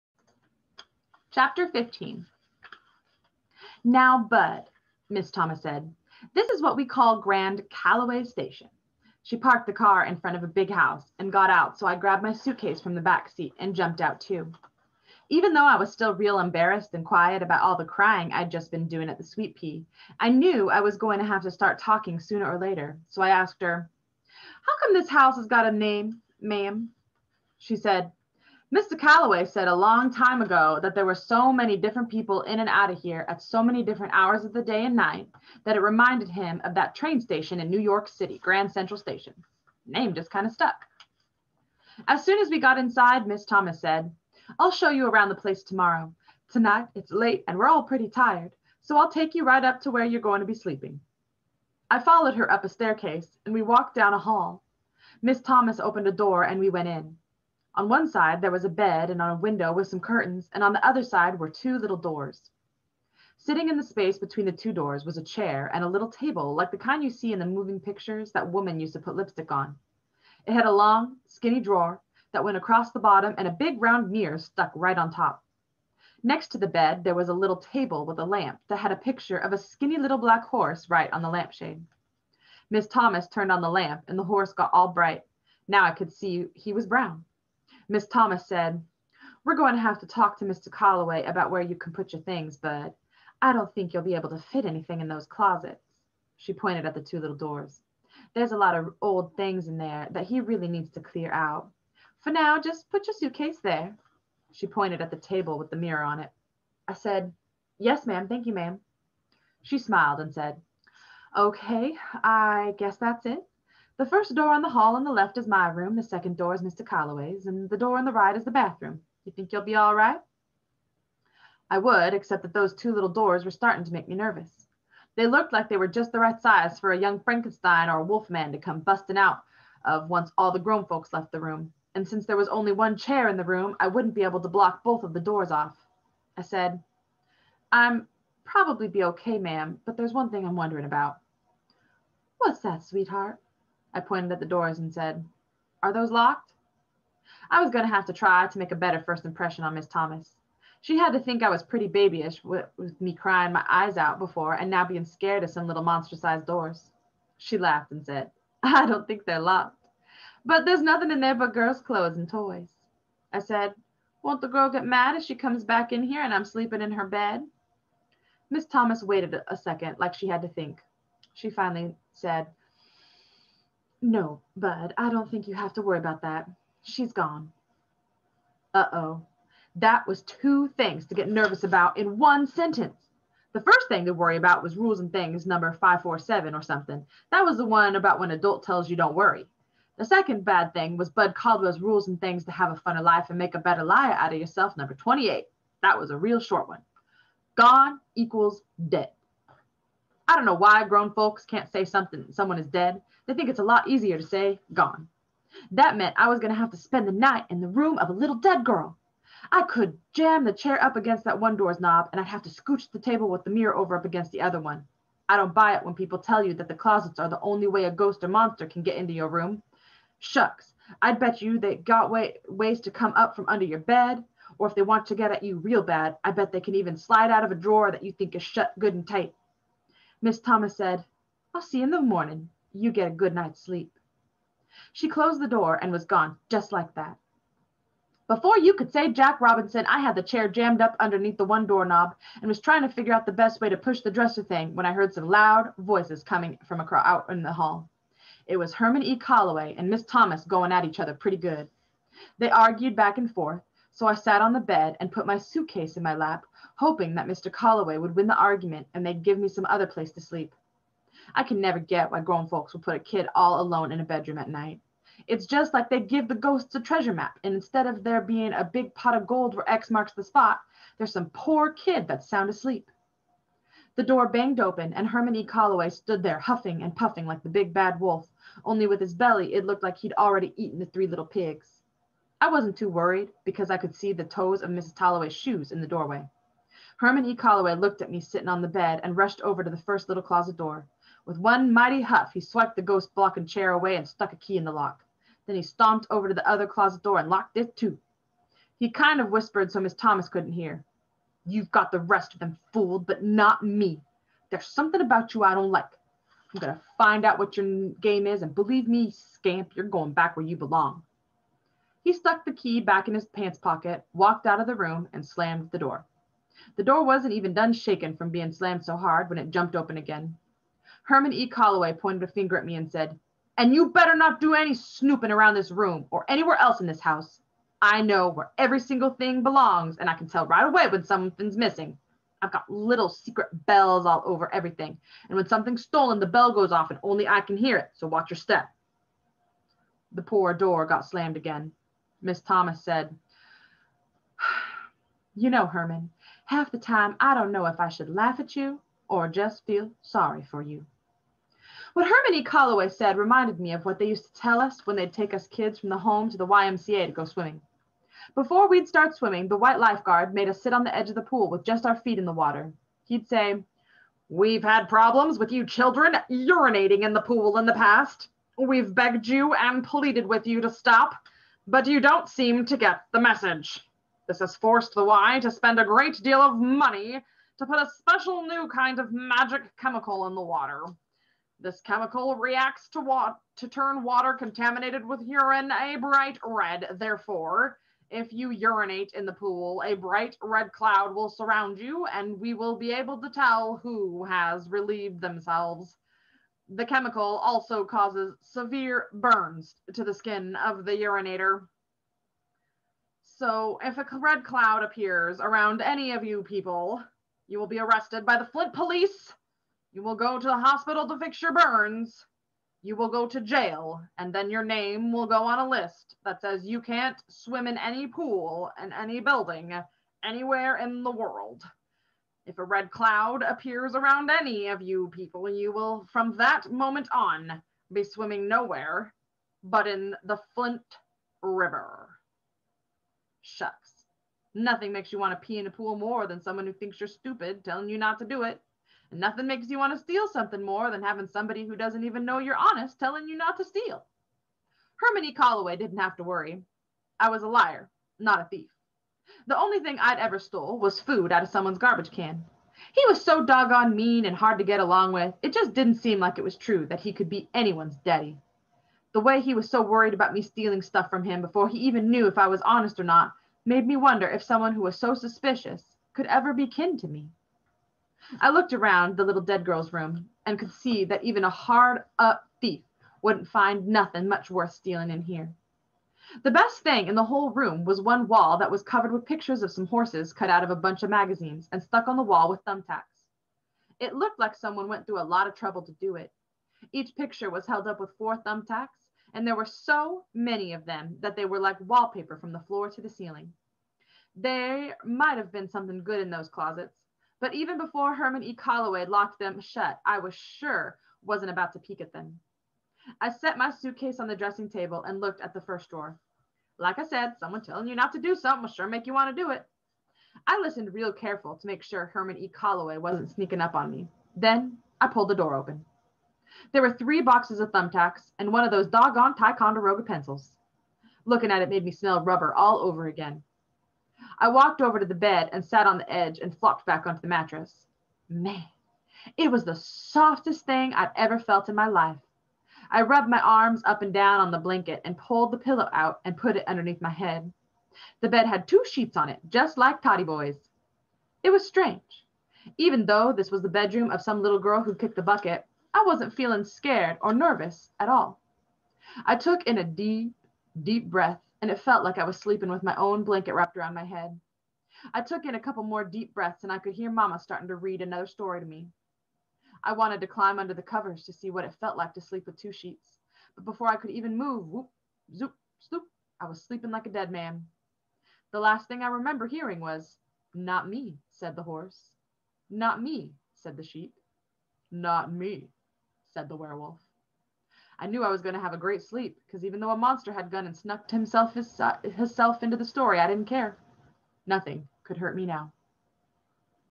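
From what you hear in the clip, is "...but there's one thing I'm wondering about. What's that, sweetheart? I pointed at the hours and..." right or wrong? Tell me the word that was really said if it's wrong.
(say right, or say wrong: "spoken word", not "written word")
wrong: "doors", not "hours".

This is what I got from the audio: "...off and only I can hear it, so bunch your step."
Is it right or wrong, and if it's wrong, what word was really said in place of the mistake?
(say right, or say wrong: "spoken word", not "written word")
wrong: "watch", not "bunch".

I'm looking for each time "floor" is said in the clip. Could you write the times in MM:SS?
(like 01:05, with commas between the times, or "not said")
08:12.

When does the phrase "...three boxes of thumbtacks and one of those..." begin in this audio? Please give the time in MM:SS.
08:36.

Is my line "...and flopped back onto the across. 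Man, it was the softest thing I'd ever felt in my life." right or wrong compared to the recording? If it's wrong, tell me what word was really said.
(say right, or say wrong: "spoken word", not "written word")
wrong: "mattress", not "across".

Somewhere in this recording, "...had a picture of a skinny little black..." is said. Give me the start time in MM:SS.
01:18.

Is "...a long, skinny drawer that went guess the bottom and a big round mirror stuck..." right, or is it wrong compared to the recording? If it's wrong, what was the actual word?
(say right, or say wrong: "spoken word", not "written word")
wrong: "across", not "guess".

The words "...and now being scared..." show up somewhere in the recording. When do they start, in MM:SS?
02:34.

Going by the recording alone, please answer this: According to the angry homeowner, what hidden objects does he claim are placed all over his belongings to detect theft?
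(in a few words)
Secret bells.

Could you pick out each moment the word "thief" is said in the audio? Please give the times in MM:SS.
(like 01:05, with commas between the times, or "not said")
07:28, 07:52.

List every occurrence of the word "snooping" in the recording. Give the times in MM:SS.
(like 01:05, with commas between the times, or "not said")
05:24.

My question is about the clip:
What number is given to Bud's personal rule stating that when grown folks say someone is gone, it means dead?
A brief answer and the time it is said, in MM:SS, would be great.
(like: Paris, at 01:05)
28, at 03:14.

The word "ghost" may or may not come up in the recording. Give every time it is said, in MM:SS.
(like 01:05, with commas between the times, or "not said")
03:37, 04:26, 04:52.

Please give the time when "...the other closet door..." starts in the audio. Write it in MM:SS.
04:56.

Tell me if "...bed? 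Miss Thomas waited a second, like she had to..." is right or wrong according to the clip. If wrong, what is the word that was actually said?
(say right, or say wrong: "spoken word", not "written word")
right.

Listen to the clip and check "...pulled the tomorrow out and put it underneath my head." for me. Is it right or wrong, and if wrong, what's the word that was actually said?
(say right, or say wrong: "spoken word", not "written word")
wrong: "pillow", not "tomorrow".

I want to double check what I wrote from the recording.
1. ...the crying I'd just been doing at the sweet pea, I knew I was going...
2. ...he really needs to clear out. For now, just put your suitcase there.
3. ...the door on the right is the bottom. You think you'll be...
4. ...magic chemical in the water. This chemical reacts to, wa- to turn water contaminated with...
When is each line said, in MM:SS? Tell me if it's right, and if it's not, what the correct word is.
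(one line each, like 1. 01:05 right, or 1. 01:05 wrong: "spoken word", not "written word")
1. 00:17 right
2. 01:40 right
3. 01:57 wrong: "bathroom", not "bottom"
4. 06:19 right.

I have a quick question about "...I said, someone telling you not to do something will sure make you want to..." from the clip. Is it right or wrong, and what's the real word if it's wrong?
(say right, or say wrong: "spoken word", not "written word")
right.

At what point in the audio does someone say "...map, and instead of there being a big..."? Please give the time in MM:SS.
04:27.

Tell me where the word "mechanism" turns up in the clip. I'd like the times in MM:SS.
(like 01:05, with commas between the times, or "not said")
not said.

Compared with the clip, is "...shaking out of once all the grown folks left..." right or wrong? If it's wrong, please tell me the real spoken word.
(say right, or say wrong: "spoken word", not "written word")
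wrong: "busting", not "shaking".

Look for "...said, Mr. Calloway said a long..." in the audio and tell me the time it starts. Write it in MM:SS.
00:27.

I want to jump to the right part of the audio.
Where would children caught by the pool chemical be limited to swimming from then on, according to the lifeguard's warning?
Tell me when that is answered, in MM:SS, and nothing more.
07:10.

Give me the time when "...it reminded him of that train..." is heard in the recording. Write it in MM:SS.
00:35.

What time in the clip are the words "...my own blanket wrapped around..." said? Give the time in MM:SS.
09:12.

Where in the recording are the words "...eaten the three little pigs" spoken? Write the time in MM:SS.
04:40.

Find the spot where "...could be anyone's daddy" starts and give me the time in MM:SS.
07:37.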